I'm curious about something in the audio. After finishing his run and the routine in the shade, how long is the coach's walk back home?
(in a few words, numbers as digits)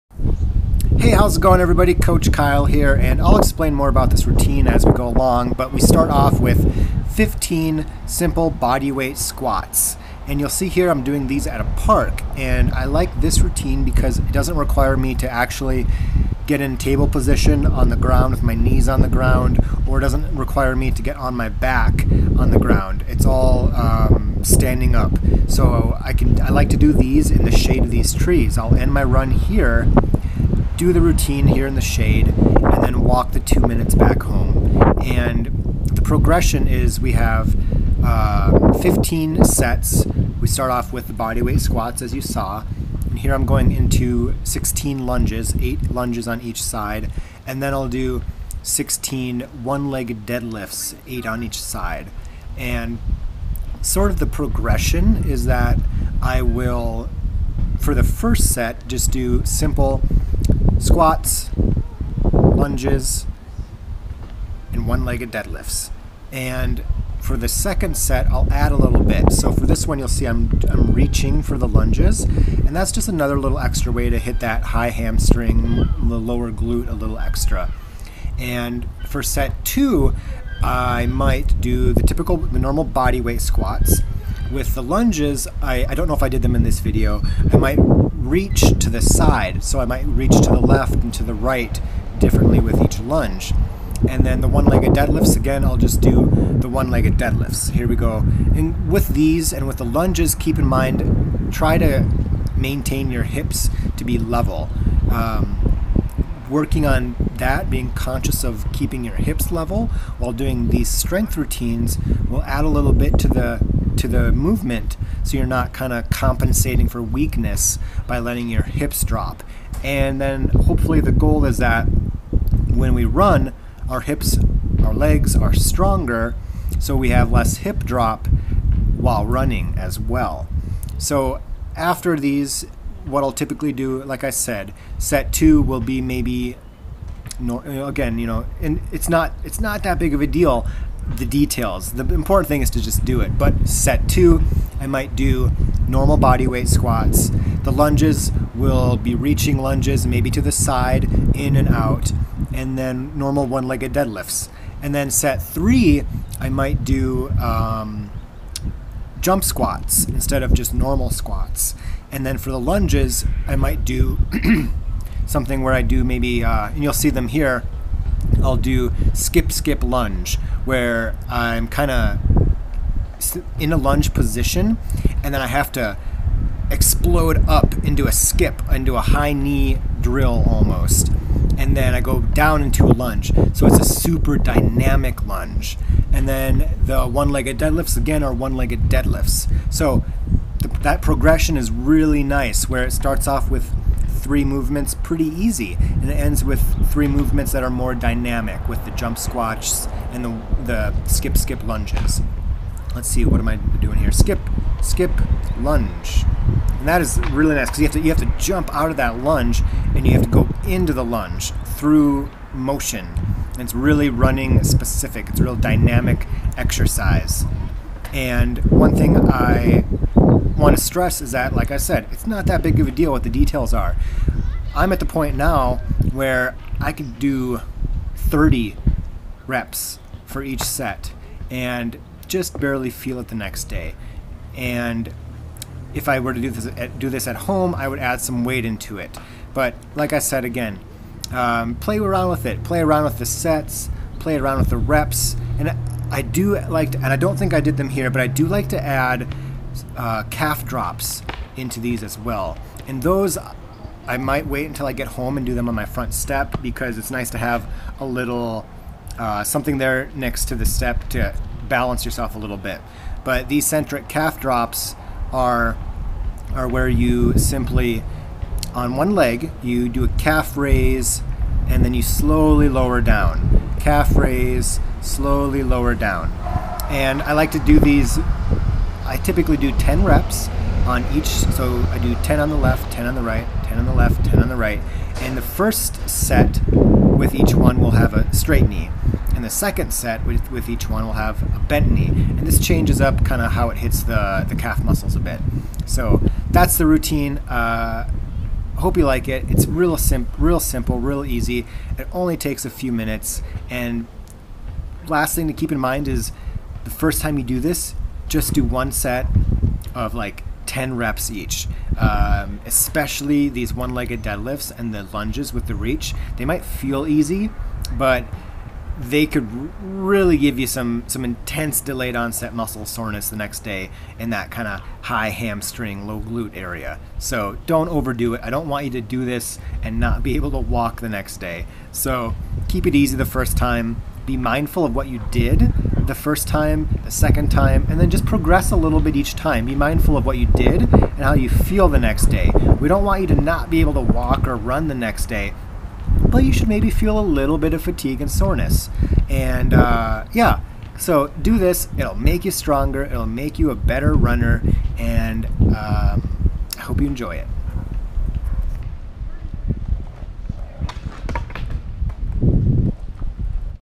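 2 minutes.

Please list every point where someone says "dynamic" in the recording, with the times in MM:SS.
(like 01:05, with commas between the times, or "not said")
03:04, 03:17, 03:35.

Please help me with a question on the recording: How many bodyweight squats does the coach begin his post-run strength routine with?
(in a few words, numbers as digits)
15.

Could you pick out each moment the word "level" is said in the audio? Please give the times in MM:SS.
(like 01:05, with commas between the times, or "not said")
01:44, 01:49.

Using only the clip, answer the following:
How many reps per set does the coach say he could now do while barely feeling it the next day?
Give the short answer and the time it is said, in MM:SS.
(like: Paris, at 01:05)
30, at 03:48.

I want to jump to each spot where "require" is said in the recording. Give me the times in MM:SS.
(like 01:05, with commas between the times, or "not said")
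00:14, 00:20.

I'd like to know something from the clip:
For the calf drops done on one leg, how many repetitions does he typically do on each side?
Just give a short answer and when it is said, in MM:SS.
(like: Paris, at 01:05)
10, at 04:39.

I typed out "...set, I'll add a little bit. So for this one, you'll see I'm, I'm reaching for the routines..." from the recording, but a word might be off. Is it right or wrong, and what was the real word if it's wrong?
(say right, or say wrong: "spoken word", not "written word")
wrong: "lunges", not "routines".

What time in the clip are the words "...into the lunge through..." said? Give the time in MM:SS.
03:30.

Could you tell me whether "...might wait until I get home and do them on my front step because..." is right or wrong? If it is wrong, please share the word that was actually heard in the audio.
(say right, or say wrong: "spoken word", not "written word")
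right.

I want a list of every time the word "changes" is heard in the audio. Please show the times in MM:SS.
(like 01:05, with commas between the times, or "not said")
04:52.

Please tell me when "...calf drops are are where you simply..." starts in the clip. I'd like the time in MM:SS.
04:24.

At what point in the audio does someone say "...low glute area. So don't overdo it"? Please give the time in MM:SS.
05:26.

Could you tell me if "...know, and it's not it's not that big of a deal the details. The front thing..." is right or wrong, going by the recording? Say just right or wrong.
wrong.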